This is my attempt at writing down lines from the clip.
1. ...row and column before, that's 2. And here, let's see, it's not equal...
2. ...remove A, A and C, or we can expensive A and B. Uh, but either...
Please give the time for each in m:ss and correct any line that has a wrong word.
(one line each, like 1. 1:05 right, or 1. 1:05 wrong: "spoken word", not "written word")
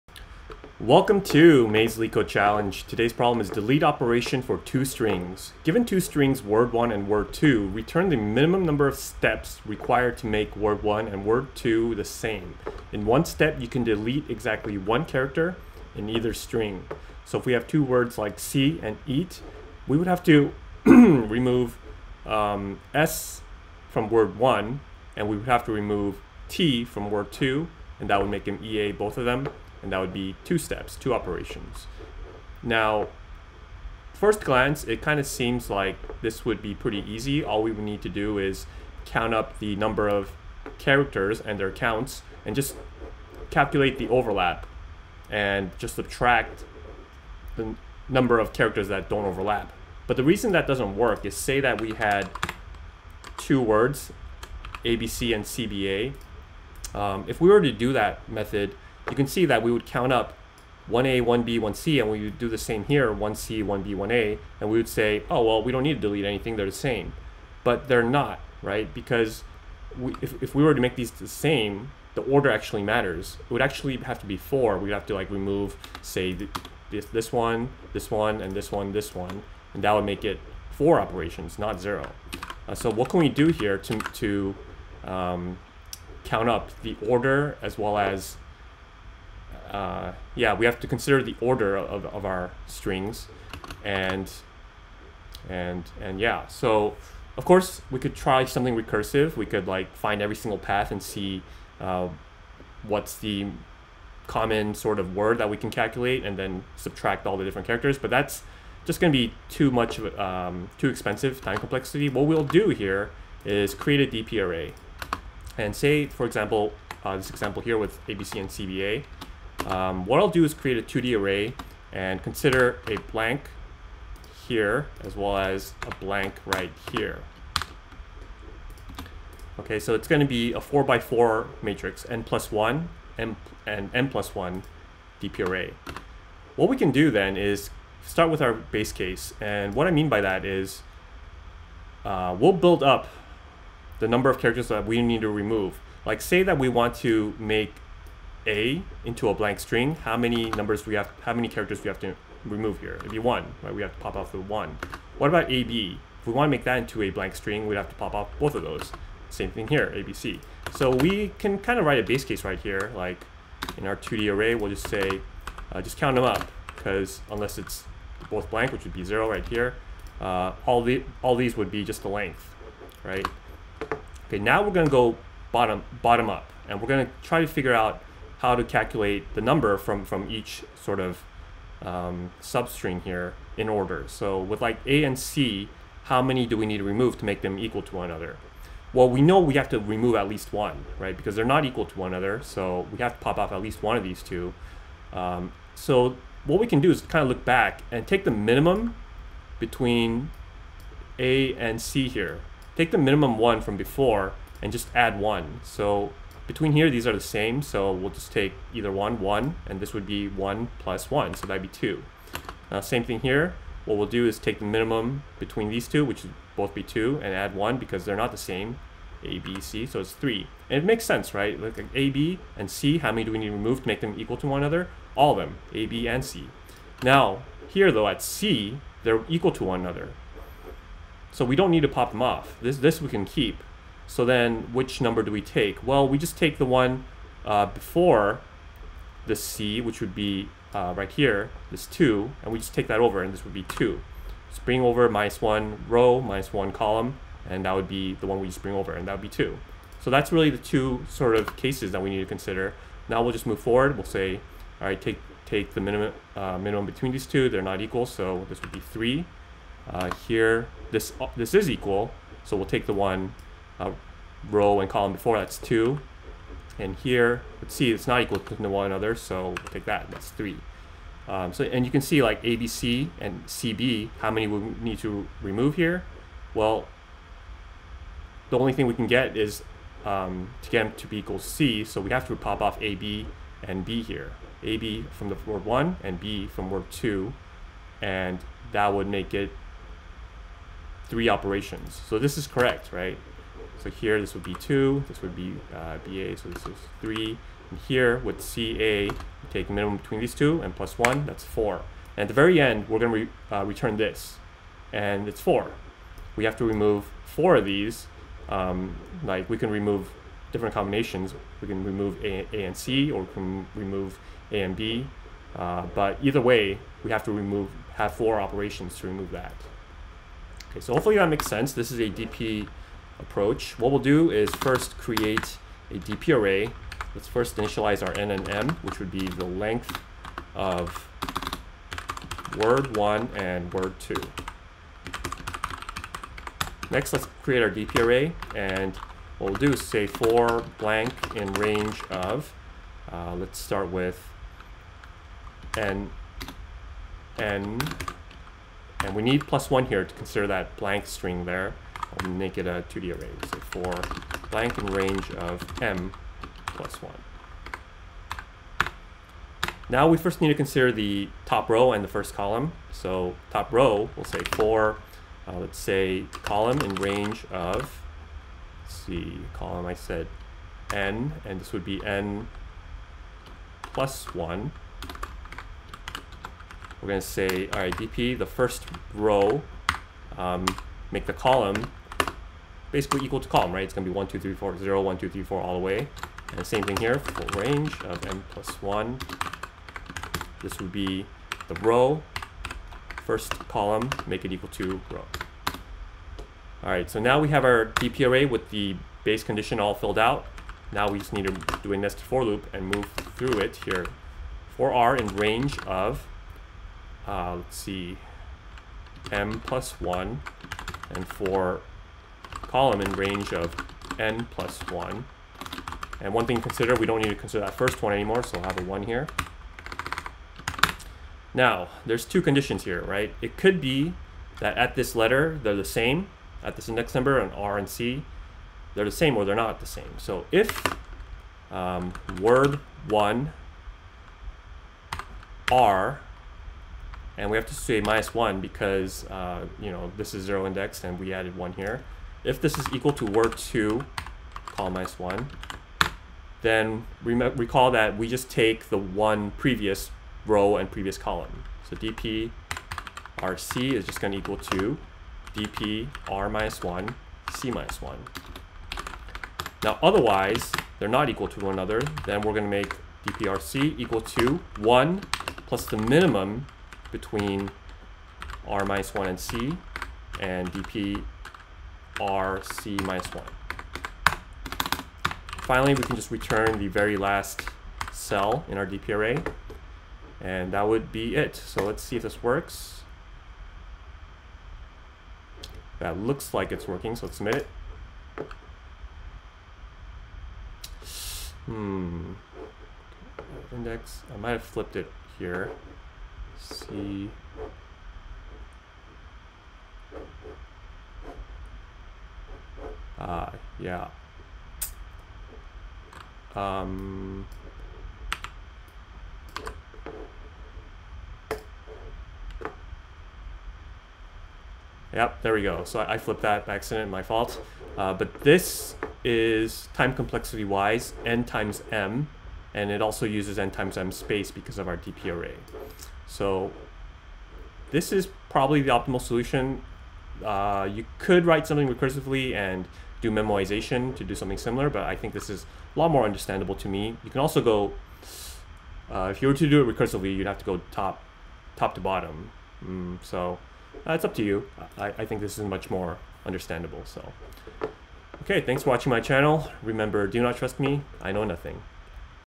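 1. 4:24 right
2. 5:11 wrong: "remove", not "expensive".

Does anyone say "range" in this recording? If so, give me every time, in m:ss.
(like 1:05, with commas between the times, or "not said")
5:41, 5:54, 6:06, 6:27, 6:45, 6:53.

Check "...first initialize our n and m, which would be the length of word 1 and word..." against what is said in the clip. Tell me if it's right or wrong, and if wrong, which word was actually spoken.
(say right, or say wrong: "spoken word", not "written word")
right.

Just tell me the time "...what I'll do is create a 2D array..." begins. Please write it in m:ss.
2:00.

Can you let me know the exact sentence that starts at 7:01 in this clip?
Now, there's two conditions here, right?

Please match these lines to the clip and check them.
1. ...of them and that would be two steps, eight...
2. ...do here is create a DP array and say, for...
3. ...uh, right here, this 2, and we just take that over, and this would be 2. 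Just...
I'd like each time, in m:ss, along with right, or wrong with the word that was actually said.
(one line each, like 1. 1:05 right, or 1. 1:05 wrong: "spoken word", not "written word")
1. 0:29 wrong: "two", not "eight"
2. 1:52 right
3. 4:00 right.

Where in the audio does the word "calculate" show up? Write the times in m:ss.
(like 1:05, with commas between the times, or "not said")
0:43, 1:45, 2:58.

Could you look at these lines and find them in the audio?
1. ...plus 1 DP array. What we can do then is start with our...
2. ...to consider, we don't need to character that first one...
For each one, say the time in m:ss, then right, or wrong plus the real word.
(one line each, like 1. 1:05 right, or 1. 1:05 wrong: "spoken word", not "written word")
1. 2:14 right
2. 6:56 wrong: "consider", not "character".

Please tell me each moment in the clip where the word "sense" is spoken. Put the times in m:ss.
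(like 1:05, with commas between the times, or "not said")
3:41, 5:21.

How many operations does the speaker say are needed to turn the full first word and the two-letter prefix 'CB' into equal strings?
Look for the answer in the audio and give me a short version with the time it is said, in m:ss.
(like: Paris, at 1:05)
3, at 4:51.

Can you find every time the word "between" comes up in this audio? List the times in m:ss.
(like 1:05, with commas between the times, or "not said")
3:19, 3:26, 3:35, 4:16, 4:59, 7:47.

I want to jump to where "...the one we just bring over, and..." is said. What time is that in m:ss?
4:08.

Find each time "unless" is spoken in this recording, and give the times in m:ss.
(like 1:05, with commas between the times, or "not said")
2:47.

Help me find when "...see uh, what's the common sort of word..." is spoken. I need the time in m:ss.
1:41.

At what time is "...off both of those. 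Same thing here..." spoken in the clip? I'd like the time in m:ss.
2:38.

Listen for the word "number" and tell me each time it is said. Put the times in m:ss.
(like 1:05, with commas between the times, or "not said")
0:08, 0:39, 0:48, 2:24, 2:30, 2:59, 3:54, 7:07.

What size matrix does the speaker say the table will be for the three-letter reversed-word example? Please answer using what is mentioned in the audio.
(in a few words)
4 by 4.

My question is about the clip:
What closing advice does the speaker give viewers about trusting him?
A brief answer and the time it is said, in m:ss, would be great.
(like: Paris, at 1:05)
do not trust me, at 9:10.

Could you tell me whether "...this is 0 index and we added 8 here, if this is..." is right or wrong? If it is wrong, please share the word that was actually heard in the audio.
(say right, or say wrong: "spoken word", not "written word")
wrong: "1", not "8".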